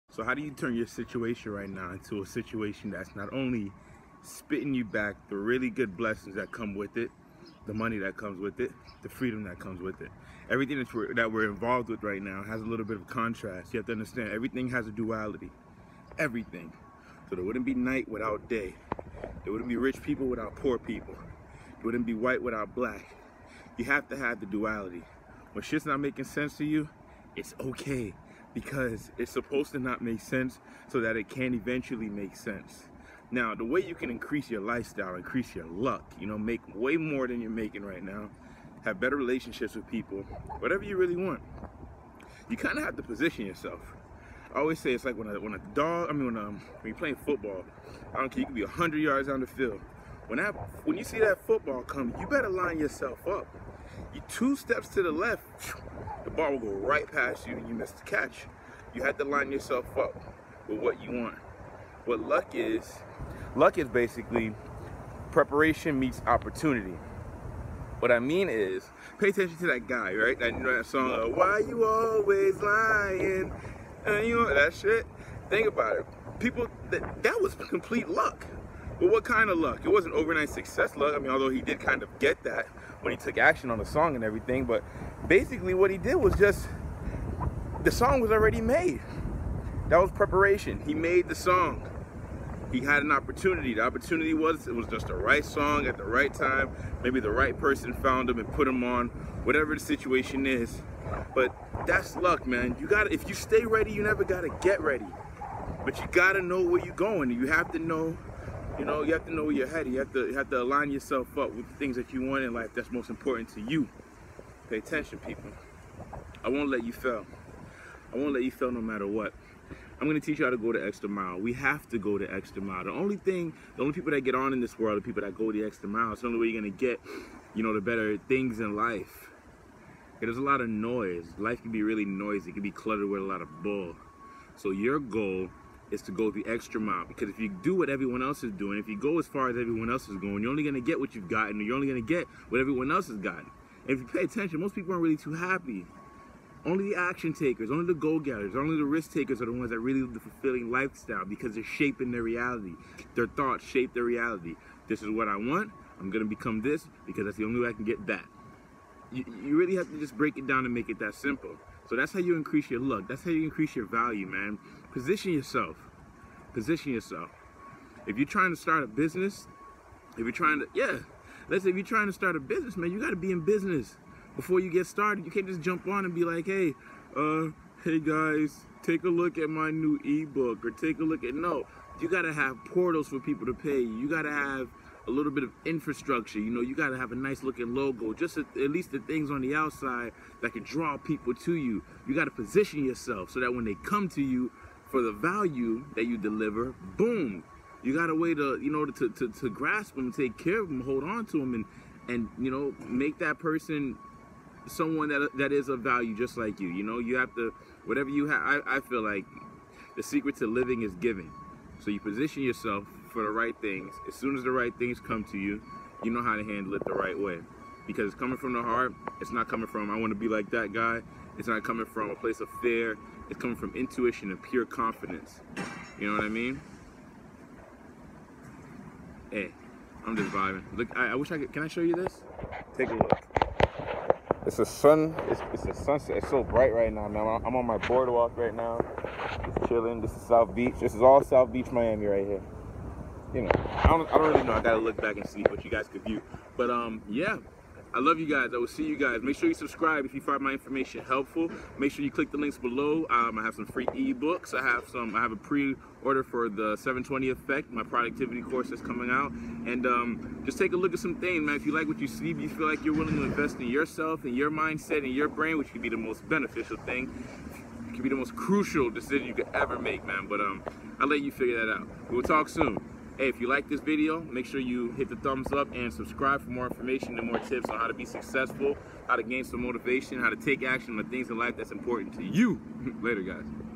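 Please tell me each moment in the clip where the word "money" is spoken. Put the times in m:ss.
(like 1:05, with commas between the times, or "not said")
0:07.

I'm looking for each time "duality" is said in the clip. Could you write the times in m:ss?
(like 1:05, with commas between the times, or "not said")
0:14, 0:24.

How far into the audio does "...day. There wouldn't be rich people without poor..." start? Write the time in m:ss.
0:18.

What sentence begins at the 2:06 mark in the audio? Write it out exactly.
It's the only way you're gonna get, you know, the better things in life.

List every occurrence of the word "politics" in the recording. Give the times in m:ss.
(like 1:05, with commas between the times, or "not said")
not said.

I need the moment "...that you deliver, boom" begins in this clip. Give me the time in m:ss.
3:15.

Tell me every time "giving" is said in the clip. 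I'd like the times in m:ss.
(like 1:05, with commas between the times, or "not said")
3:30.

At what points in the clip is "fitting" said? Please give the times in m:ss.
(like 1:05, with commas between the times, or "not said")
not said.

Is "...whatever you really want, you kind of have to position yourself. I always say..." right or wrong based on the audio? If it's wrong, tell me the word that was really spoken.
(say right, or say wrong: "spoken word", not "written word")
right.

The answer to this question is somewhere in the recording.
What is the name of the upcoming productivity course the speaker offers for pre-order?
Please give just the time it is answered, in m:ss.
4:16.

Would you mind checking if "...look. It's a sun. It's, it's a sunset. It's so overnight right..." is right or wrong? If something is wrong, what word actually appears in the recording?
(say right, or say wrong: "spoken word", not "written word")
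wrong: "bright", not "overnight".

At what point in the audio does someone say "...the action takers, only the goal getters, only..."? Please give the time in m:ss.
2:26.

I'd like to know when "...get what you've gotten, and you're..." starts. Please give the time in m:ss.
2:20.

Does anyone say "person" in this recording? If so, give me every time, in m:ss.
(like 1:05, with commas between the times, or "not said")
1:37, 3:23.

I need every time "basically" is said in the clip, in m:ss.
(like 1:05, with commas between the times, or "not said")
1:03, 1:25.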